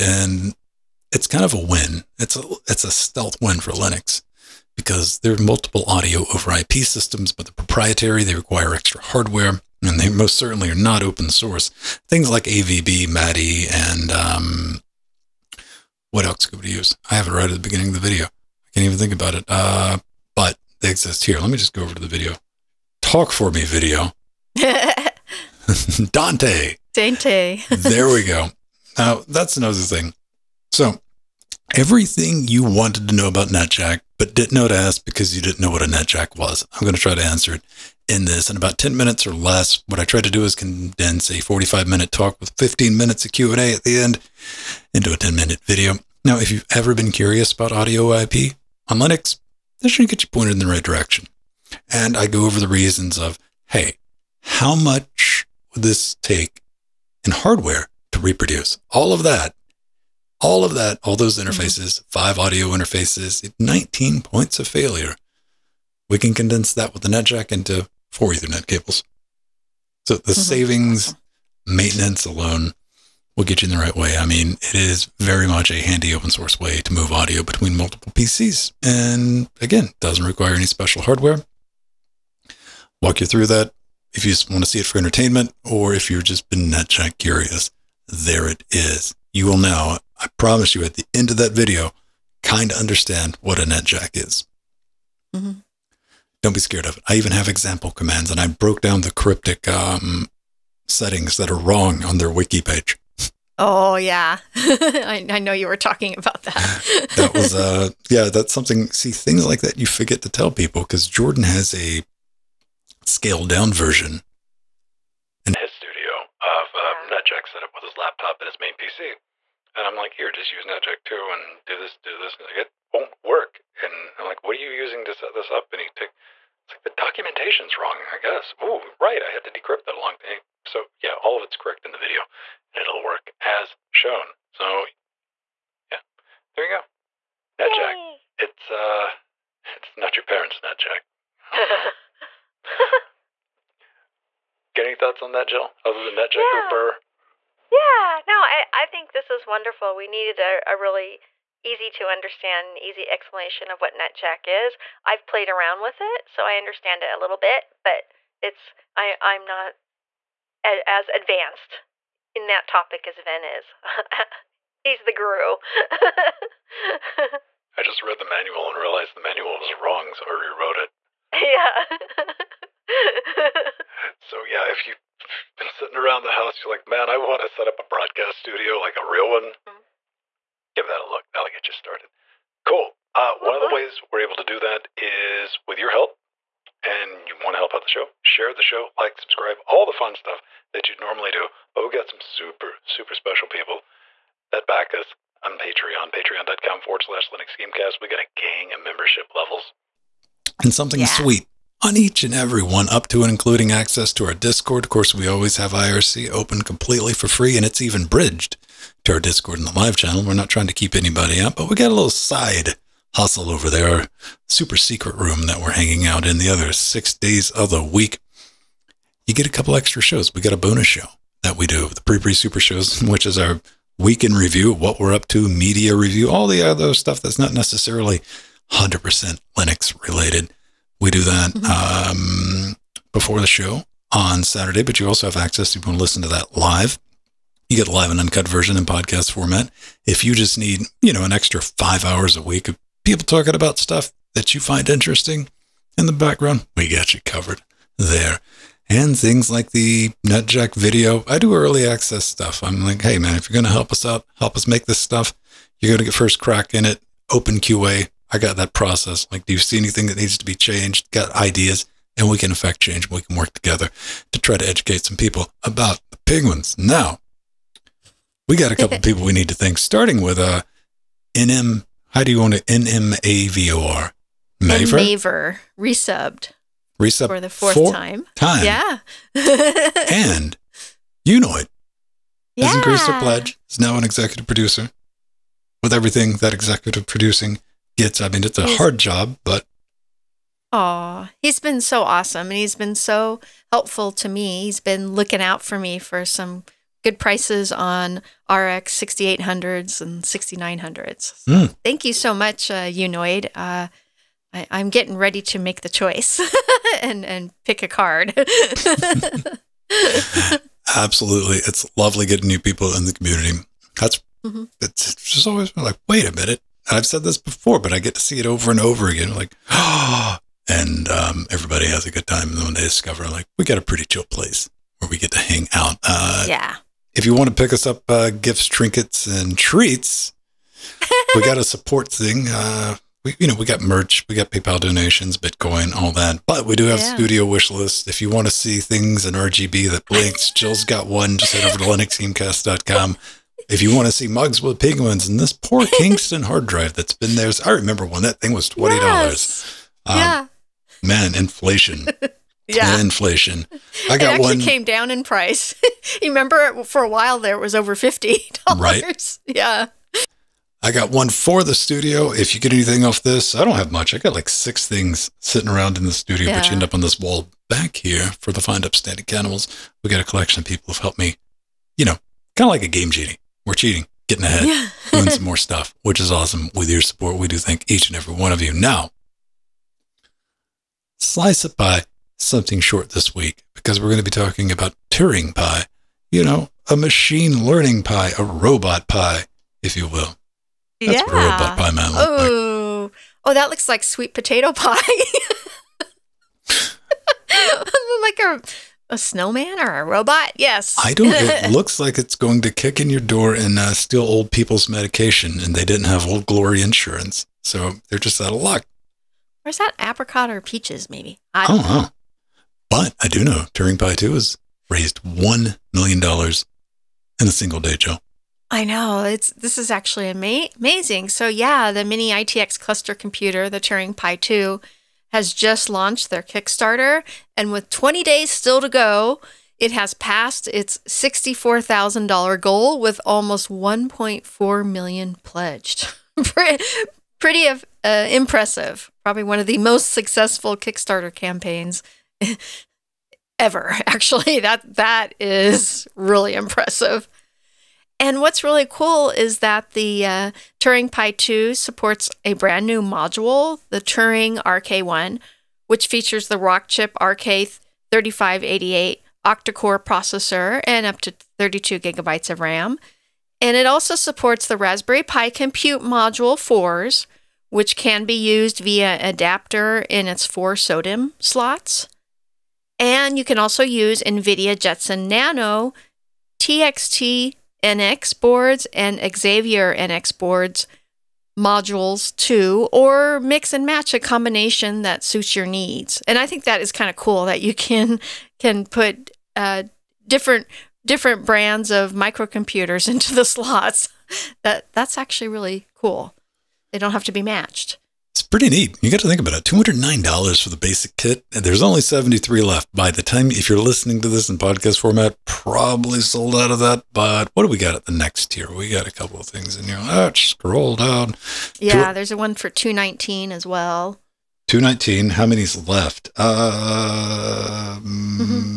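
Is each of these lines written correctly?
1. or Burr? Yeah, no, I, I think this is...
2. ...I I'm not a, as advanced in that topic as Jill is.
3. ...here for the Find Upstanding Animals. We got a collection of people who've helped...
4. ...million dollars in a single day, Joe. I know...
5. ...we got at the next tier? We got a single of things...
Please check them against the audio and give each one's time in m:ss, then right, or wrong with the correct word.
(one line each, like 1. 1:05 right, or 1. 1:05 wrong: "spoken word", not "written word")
1. 2:26 right
2. 2:38 wrong: "Ven", not "Jill"
3. 6:07 right
4. 6:55 right
5. 8:27 wrong: "couple", not "single".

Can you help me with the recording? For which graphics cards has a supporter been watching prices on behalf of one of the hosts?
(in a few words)
RX 6800s and 6900s.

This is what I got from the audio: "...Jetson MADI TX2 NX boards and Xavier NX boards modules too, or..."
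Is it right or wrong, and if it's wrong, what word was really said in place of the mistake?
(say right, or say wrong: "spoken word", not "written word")
wrong: "Nano", not "MADI".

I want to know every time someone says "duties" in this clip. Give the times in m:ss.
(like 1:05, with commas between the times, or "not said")
not said.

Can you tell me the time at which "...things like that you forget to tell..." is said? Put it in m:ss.
1:49.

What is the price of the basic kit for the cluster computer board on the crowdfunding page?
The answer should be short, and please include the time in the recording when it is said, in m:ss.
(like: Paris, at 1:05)
$209, at 8:19.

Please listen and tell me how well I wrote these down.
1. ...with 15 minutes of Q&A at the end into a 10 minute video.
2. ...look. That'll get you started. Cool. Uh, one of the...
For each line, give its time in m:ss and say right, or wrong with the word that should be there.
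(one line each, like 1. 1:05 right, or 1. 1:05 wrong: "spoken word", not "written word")
1. 0:42 right
2. 3:01 right.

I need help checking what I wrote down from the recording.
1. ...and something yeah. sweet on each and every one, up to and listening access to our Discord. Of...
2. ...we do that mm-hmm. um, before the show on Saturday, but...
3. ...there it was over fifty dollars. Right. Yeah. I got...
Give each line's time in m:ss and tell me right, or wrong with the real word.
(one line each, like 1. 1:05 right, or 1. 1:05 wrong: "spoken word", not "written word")
1. 3:20 wrong: "including", not "listening"
2. 3:50 right
3. 5:57 right.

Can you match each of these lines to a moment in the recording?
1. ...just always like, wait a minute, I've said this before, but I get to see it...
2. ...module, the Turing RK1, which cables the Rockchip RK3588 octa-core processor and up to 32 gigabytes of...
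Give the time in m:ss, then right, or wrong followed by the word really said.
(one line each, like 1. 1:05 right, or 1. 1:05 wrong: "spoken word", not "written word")
1. 5:15 right
2. 7:33 wrong: "features", not "cables".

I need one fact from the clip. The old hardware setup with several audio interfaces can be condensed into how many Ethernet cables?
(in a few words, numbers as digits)
4.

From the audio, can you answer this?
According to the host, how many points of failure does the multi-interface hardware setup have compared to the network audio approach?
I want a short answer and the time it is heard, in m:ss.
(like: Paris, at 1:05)
19, at 1:03.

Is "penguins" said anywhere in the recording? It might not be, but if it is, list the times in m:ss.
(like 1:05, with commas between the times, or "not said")
4:26, 5:44.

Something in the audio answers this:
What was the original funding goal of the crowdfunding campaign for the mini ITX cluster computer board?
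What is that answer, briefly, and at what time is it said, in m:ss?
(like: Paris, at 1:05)
$64,000, at 7:11.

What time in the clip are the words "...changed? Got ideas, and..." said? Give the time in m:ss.
4:20.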